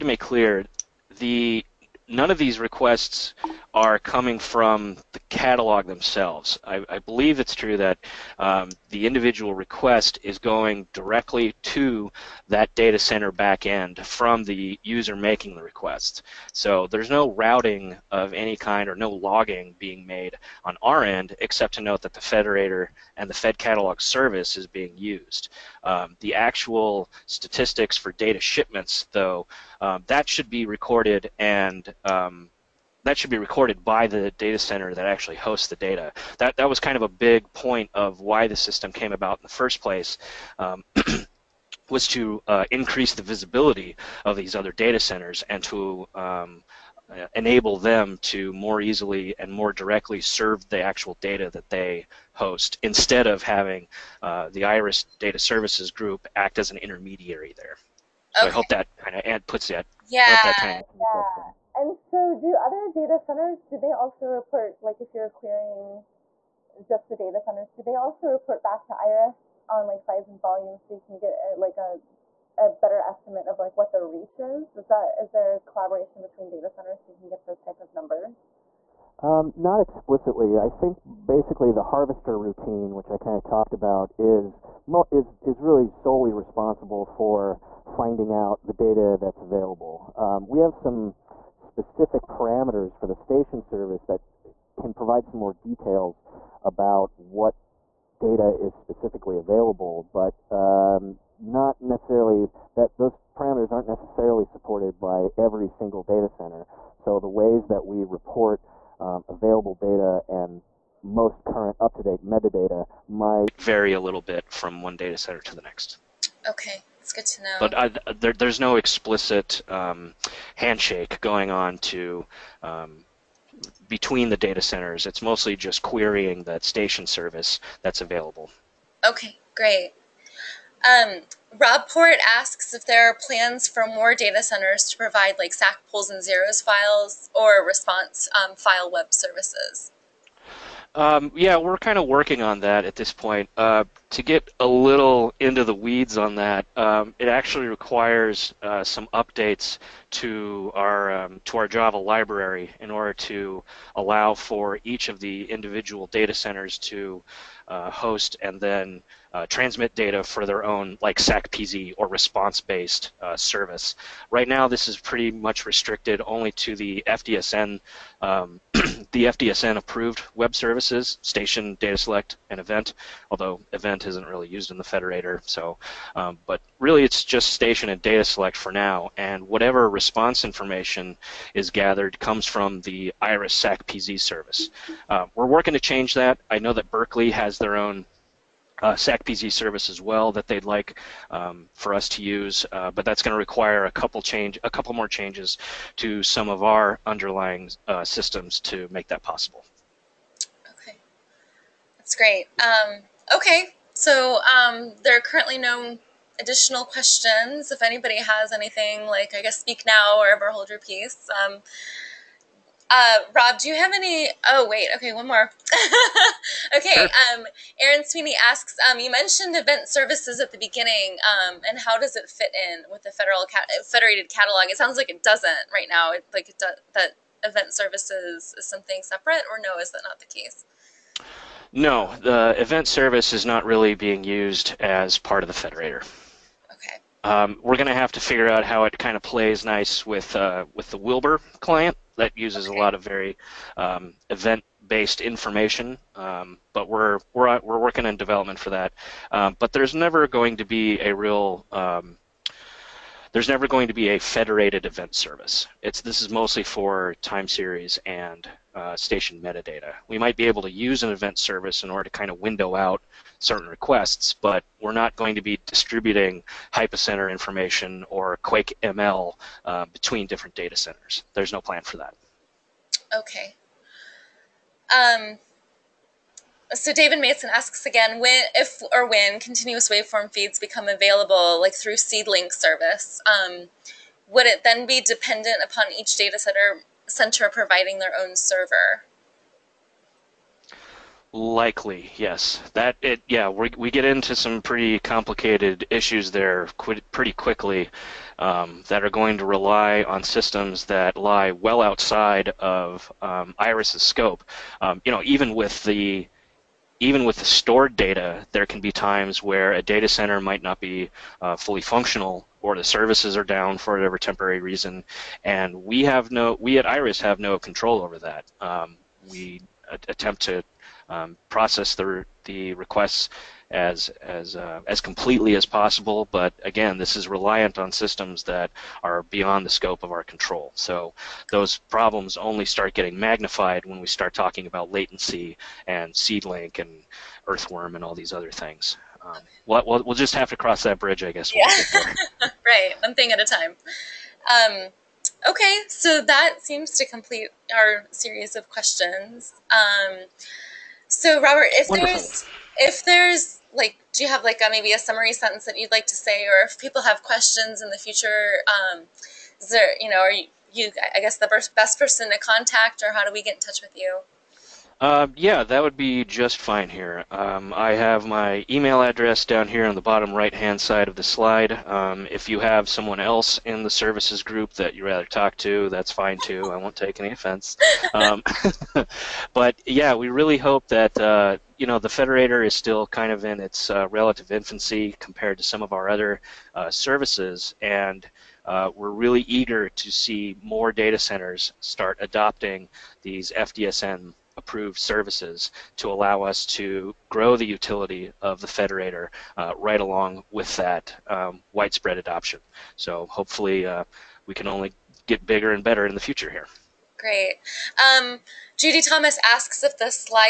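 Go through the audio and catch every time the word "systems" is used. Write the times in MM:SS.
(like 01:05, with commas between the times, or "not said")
00:38, 03:18, 05:00, 05:27.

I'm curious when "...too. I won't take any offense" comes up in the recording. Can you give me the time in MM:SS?
06:16.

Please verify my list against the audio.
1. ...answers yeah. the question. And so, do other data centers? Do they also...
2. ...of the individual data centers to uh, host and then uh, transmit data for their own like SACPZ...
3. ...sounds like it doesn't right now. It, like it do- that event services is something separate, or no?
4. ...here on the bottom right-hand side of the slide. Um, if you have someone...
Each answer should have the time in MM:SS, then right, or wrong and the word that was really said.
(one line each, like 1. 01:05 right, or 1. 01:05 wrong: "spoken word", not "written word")
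1. 01:00 right
2. 02:35 right
3. 03:44 right
4. 06:09 right.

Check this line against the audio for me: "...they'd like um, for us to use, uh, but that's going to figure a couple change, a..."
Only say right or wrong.
wrong.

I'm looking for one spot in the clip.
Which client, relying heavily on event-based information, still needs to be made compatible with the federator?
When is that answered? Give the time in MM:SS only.
04:00.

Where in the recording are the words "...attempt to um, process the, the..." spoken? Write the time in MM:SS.
05:20.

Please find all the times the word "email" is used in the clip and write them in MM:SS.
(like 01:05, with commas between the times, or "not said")
06:08.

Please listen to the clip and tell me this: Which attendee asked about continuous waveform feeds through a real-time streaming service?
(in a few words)
David Mason.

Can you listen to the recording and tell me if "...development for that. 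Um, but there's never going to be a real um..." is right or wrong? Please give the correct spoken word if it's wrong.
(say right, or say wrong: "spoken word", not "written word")
right.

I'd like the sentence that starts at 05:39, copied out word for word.
Um, we'll, we'll, we'll, just have to cross that bridge, I guess.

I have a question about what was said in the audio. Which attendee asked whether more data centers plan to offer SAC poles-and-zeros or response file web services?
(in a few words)
Rob Port.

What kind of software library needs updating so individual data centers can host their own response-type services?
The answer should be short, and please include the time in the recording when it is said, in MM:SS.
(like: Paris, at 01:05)
Java library, at 02:31.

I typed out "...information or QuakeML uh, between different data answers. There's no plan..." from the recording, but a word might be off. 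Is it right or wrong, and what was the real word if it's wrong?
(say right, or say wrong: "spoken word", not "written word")
wrong: "centers", not "answers".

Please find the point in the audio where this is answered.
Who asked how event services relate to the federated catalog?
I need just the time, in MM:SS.
03:37.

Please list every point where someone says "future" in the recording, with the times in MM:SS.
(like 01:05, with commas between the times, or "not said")
05:57, 06:46.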